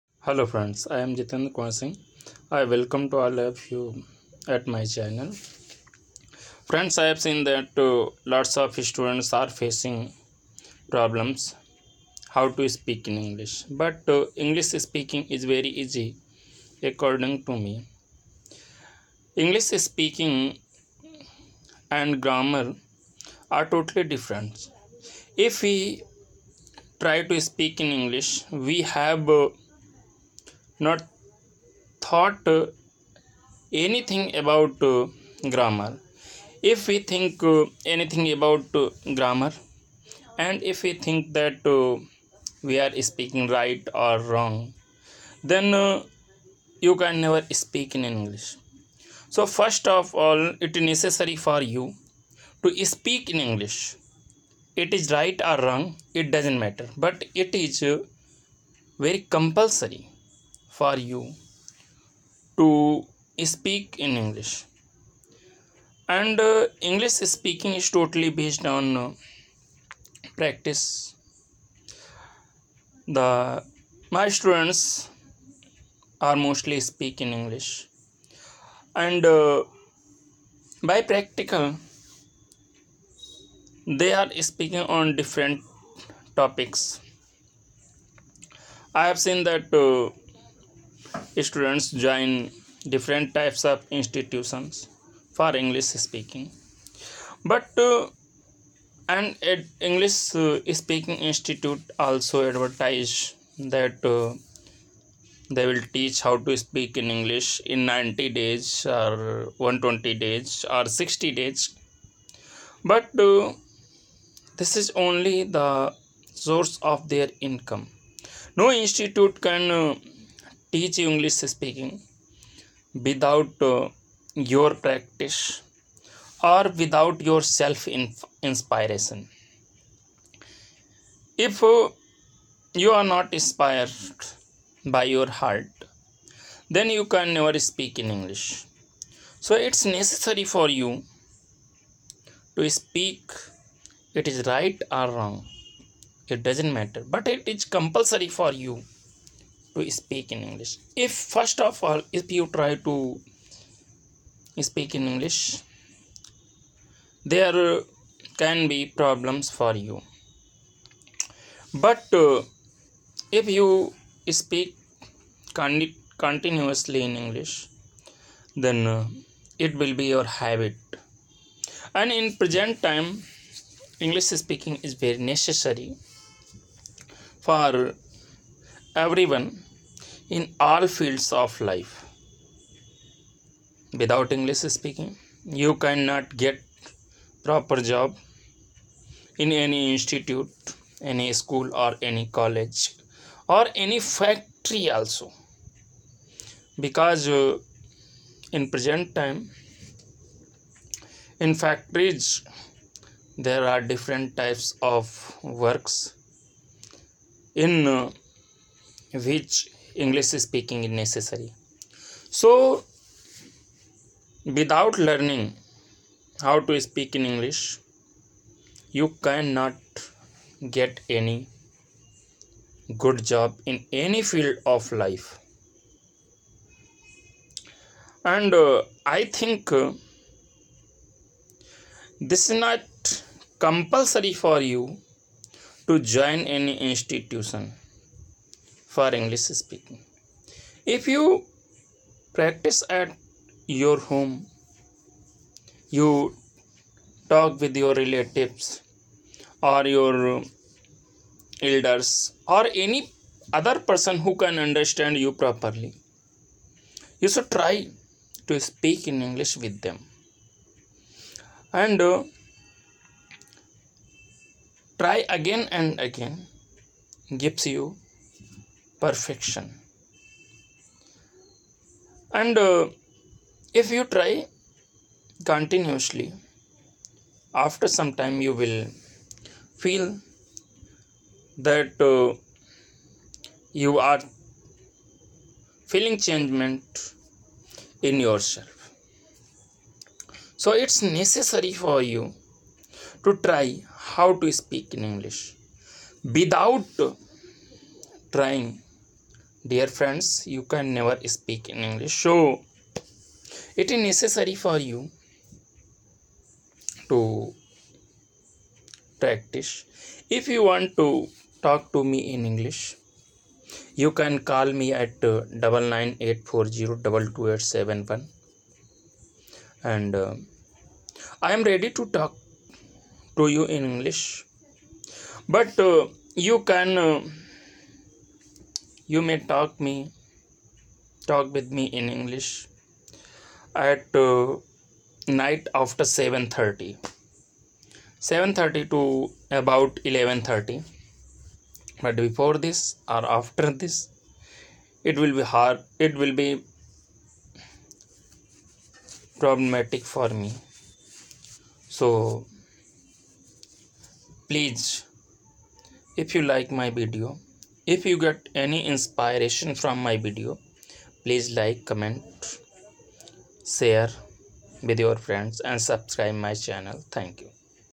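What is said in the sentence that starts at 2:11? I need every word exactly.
If uh, you are not inspired by your heart, then you can never speak in English.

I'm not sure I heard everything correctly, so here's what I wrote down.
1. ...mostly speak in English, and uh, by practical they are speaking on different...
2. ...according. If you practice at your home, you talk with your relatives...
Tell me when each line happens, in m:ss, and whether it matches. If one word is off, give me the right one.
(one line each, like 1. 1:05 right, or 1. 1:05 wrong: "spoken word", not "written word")
1. 1:16 right
2. 3:59 wrong: "speaking", not "according".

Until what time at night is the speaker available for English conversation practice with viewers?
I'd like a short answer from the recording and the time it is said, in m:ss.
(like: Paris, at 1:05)
11:30, at 5:40.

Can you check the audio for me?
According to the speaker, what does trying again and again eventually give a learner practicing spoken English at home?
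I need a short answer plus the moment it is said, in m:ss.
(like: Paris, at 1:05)
perfection, at 4:29.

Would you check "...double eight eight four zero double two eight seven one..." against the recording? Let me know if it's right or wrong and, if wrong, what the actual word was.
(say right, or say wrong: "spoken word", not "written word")
wrong: "nine", not "eight".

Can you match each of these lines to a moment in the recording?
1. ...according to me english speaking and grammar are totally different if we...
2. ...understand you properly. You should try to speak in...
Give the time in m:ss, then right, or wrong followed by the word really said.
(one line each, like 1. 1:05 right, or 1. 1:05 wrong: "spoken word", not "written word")
1. 0:16 right
2. 4:14 right.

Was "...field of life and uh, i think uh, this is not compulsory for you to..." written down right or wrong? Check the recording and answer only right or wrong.
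right.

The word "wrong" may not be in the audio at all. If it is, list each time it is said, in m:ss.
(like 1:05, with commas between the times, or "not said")
0:44, 0:55, 2:25.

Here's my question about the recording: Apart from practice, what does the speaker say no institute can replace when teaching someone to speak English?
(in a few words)
self inspiration.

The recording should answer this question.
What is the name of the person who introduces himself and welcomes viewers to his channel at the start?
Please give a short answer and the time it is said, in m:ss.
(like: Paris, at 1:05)
Jitin Kumar Singh, at 0:01.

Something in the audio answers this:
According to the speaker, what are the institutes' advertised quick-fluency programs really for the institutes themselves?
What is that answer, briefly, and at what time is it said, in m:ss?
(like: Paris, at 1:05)
source of their income, at 1:56.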